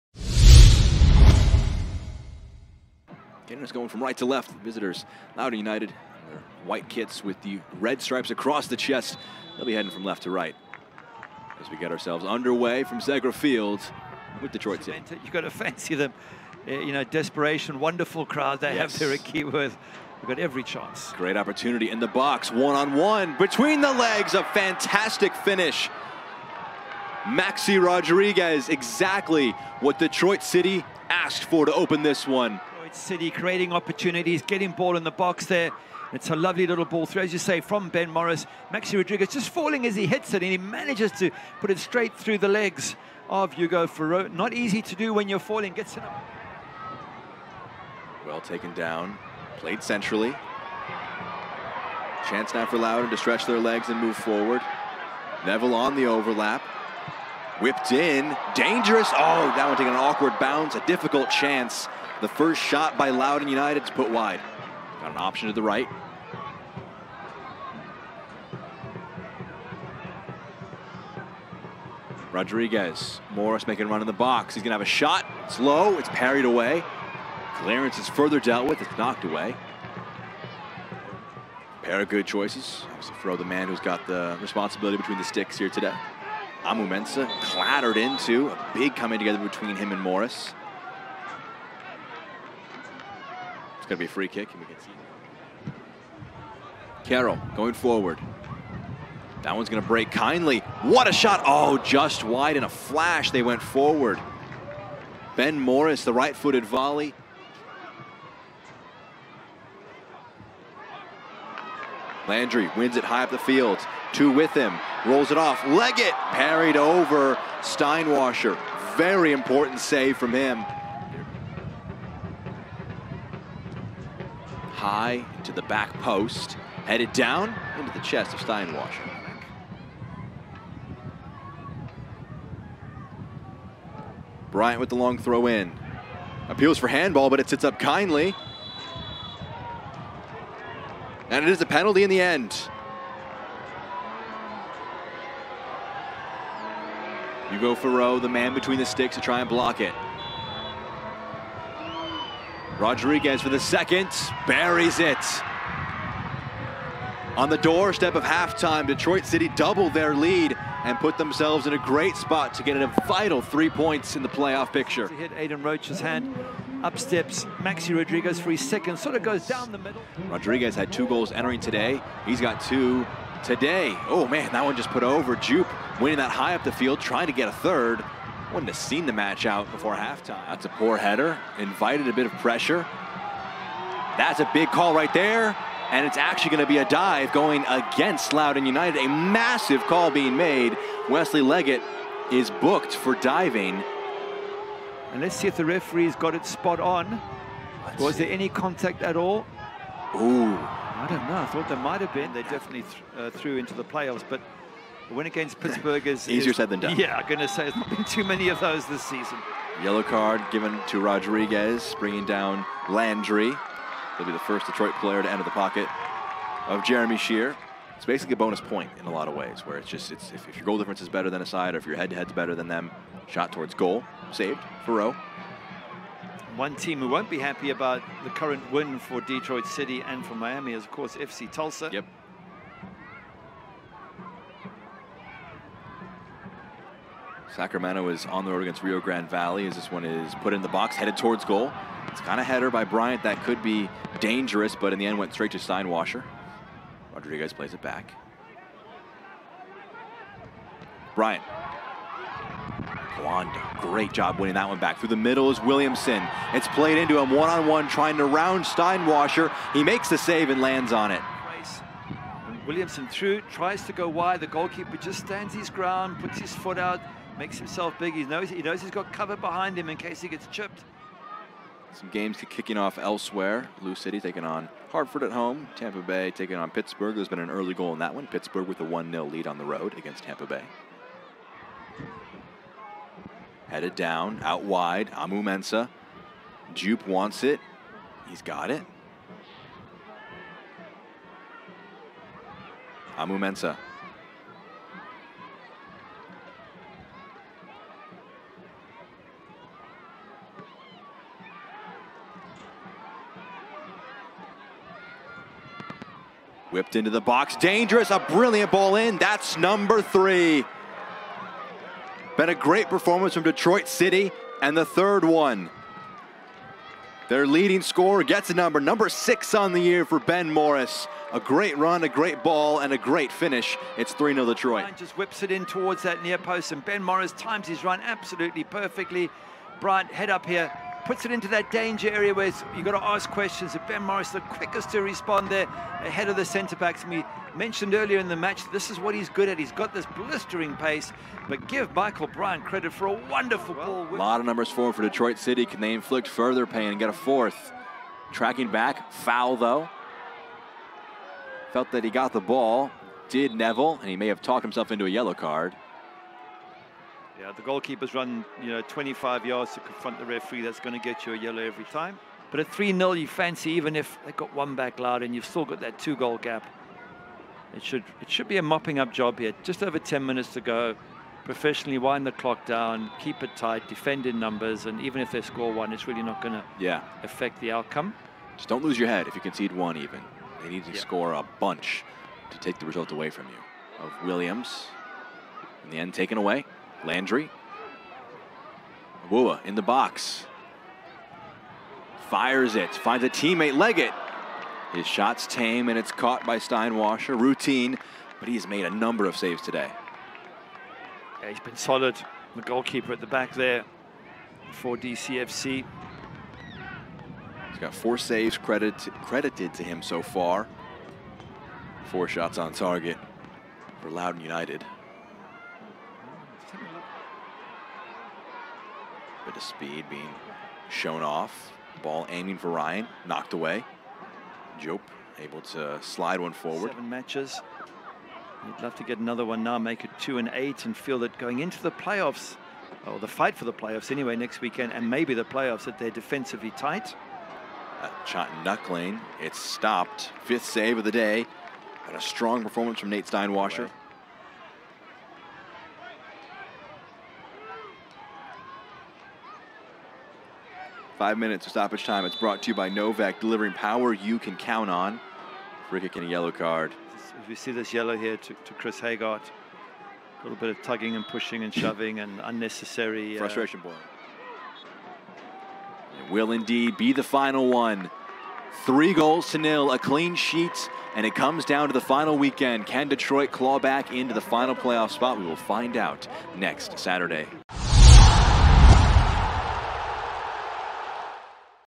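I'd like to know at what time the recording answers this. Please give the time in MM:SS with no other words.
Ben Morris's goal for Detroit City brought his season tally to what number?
05:18.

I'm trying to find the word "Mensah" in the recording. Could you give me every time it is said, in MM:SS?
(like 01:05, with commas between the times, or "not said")
01:26, 04:45, 04:53.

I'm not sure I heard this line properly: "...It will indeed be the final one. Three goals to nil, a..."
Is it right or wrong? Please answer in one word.
right.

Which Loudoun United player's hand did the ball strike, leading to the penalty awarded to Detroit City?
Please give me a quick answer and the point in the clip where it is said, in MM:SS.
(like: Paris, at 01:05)
Aidan Rocha, at 02:45.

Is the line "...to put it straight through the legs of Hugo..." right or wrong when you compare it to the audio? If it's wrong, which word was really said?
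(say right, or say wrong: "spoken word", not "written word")
right.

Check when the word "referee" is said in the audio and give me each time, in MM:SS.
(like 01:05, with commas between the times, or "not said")
03:15, 06:00.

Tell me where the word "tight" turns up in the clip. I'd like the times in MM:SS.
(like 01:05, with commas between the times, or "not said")
06:13, 07:16.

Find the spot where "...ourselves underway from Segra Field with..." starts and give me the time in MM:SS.
00:11.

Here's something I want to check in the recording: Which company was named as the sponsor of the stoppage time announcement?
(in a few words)
NOVEC.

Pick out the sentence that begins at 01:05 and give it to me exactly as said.
Got an option to the right.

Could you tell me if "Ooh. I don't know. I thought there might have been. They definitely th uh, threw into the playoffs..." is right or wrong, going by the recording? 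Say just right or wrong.
right.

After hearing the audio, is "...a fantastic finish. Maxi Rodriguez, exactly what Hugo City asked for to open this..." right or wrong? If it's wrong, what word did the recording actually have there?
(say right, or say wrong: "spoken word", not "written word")
wrong: "Detroit", not "Hugo".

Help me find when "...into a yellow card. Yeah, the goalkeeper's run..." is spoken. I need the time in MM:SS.
05:54.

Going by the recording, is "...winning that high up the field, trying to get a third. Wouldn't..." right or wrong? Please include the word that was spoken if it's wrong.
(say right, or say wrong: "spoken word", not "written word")
right.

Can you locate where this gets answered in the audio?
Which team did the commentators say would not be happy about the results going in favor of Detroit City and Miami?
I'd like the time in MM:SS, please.
03:51.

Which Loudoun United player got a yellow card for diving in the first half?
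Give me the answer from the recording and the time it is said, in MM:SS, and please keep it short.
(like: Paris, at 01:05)
Wesley Leggett, at 03:11.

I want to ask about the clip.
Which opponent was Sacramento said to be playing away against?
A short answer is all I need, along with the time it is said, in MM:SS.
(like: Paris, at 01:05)
Rio Grande Valley, at 03:58.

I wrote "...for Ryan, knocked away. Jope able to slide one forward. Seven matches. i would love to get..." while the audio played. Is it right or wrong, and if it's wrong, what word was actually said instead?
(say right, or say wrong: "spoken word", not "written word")
right.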